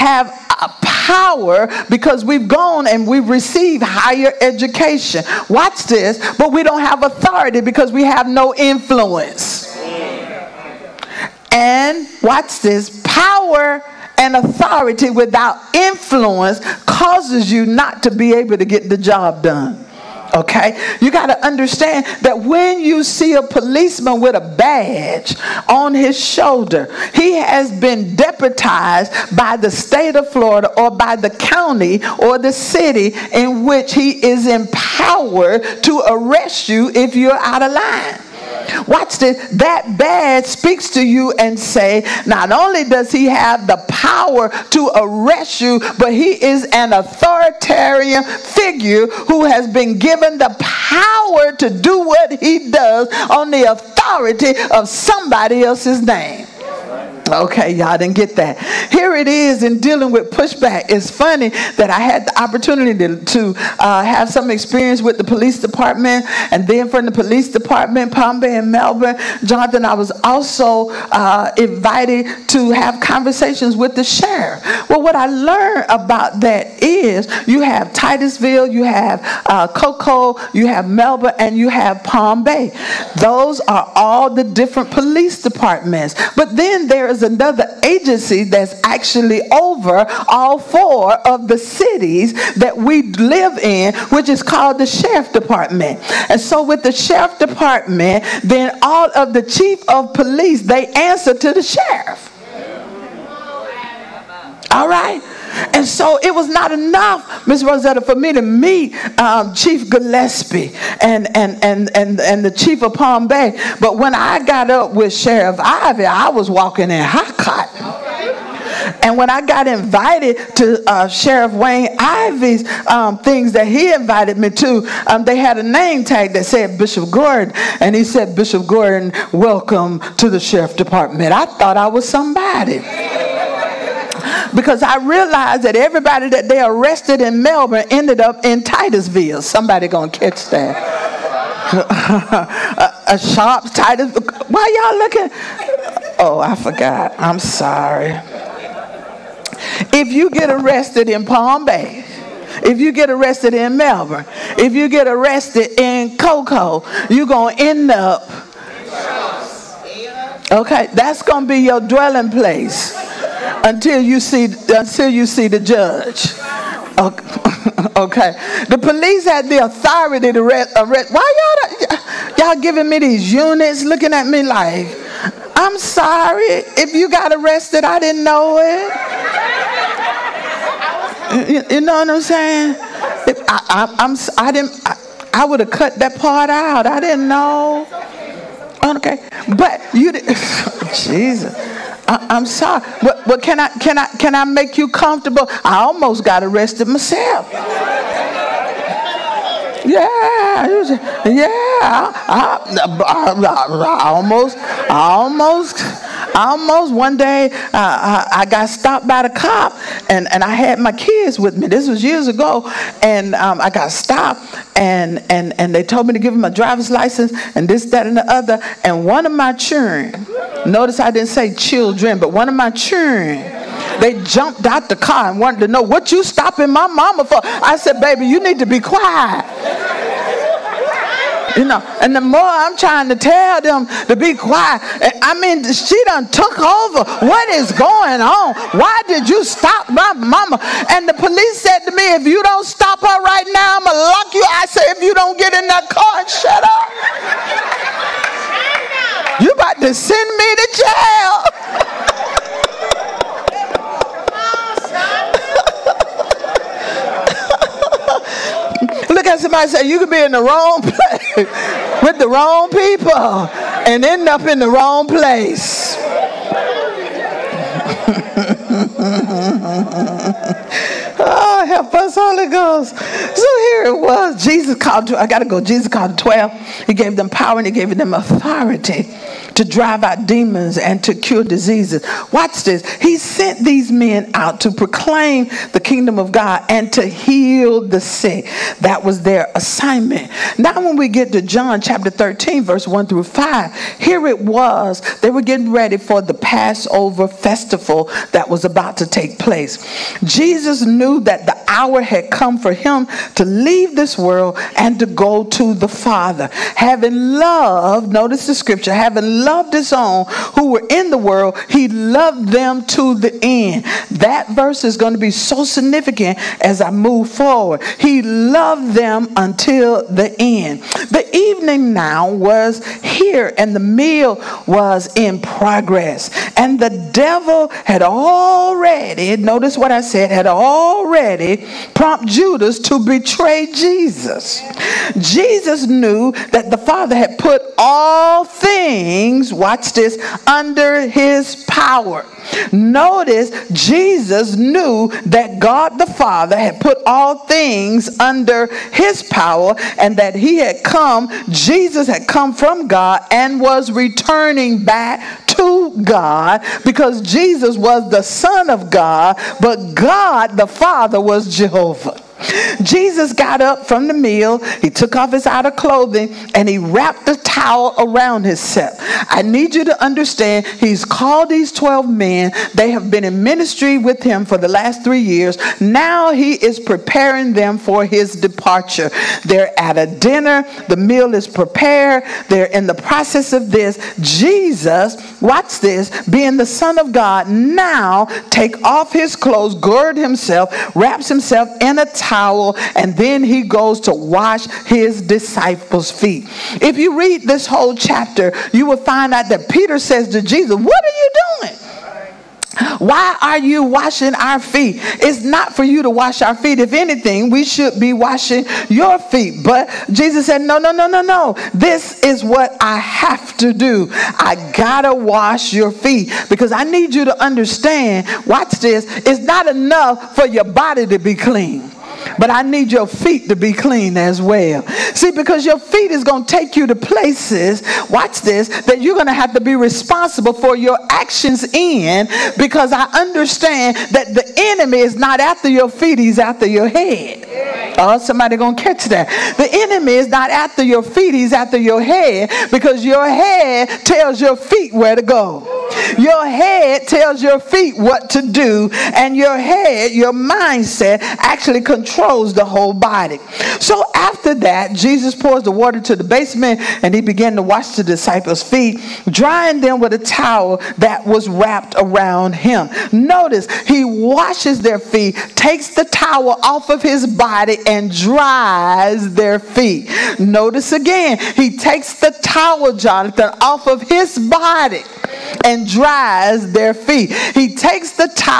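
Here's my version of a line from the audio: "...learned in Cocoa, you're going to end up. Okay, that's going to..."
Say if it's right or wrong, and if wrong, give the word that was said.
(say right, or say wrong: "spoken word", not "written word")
wrong: "arrested", not "learned".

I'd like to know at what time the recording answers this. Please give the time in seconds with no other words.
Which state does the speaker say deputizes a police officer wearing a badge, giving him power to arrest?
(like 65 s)
29 s.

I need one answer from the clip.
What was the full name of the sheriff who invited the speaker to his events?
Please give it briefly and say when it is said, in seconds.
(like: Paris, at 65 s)
Wayne Ivey, at 121 s.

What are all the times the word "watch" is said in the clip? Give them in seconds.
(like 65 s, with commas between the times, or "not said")
5 s, 12 s, 38 s, 282 s, 339 s, 385 s, 418 s, 428 s.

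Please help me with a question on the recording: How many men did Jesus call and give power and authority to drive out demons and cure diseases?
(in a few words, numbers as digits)
12.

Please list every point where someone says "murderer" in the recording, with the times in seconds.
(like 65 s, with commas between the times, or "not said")
not said.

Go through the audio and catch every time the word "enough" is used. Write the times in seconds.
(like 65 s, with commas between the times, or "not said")
106 s, 419 s.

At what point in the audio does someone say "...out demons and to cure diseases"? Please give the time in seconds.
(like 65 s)
280 s.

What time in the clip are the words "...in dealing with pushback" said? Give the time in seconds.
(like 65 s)
59 s.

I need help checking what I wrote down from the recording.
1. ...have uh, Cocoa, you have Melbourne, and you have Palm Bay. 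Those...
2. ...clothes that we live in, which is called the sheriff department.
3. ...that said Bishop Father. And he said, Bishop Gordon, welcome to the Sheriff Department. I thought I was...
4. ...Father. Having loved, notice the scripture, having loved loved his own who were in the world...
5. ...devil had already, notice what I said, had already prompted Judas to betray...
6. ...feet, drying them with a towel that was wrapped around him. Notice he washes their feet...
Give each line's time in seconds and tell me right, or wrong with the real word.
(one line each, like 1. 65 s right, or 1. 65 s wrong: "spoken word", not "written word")
1. 78 s right
2. 91 s wrong: "cities", not "clothes"
3. 126 s wrong: "Gordon", not "Father"
4. 305 s right
5. 327 s right
6. 458 s right.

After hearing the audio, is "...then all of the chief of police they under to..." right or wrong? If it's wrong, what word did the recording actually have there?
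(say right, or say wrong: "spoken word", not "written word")
wrong: "answer", not "under".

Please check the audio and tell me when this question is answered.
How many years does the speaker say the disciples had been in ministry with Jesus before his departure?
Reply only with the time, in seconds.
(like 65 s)
375 s.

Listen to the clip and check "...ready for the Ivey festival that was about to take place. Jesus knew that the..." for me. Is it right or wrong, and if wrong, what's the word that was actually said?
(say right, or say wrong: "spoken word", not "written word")
wrong: "Passover", not "Ivey".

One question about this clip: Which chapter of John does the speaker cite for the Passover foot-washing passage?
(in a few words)
Chapter 13.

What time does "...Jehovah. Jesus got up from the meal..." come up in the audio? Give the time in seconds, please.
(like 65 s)
361 s.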